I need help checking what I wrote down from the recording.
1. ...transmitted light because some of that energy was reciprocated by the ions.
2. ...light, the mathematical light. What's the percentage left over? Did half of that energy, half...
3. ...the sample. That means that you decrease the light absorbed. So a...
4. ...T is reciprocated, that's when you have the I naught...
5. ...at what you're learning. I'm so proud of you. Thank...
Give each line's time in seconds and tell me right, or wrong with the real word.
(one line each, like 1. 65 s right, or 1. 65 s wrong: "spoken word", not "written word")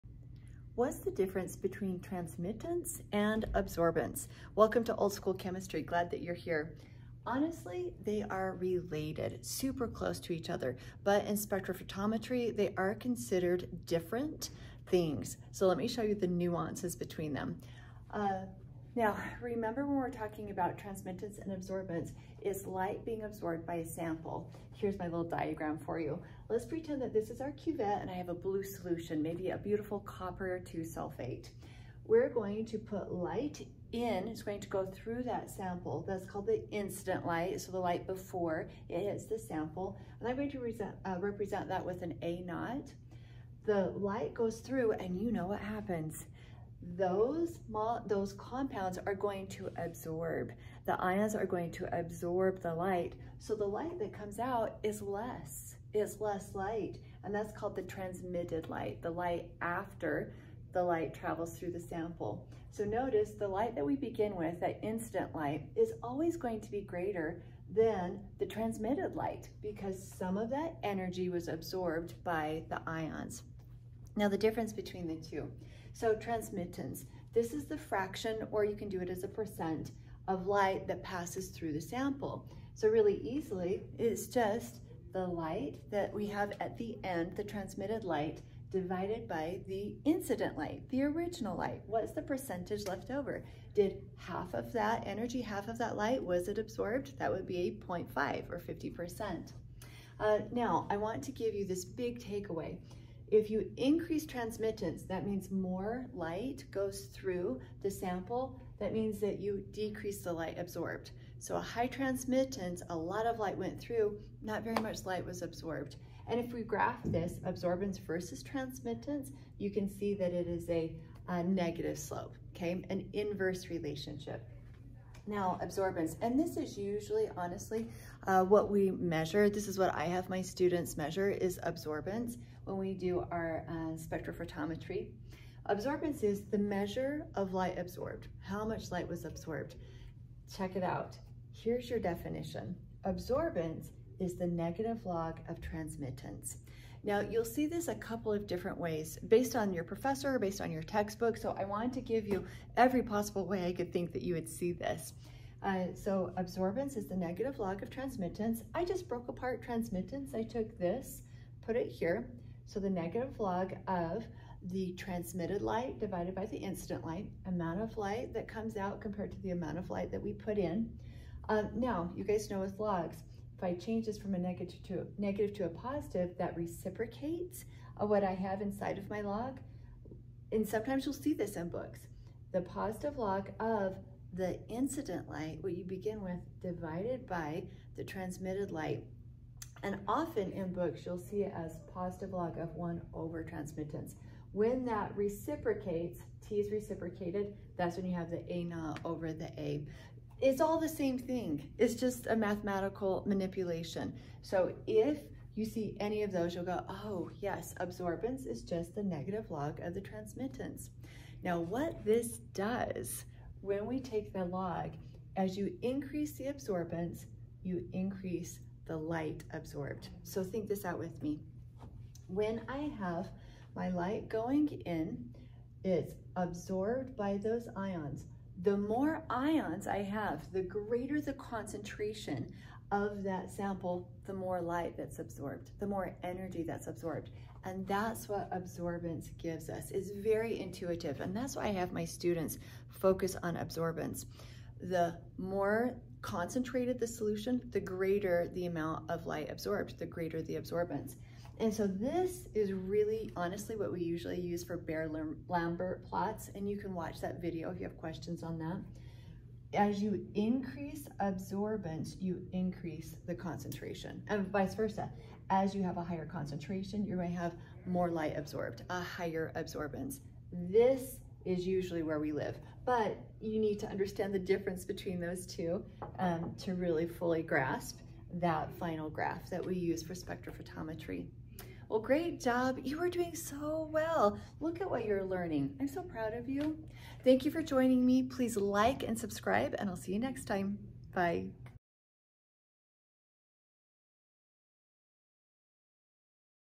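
1. 68 s wrong: "absorbed", not "reciprocated"
2. 90 s wrong: "original", not "mathematical"
3. 107 s right
4. 196 s right
5. 284 s right.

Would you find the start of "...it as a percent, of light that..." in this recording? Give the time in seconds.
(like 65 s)
78 s.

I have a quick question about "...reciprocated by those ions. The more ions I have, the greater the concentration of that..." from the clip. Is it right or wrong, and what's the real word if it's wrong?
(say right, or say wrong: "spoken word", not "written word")
wrong: "absorbed", not "reciprocated".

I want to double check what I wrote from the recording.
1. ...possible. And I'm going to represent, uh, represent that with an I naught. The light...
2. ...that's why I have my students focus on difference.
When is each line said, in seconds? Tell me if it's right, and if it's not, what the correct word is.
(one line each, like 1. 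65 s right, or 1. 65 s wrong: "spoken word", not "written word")
1. 39 s wrong: "sample", not "possible"
2. 241 s wrong: "absorbance", not "difference".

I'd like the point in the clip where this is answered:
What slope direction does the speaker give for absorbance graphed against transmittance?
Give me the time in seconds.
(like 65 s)
121 s.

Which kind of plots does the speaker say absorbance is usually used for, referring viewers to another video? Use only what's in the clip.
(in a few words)
Beer-Lambert plots.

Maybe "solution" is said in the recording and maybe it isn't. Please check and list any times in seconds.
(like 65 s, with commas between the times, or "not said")
28 s, 247 s.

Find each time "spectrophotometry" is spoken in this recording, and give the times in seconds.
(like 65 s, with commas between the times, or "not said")
11 s, 133 s, 280 s.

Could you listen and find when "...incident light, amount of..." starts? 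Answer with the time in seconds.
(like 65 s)
166 s.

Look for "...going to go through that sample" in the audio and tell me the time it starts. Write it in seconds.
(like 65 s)
34 s.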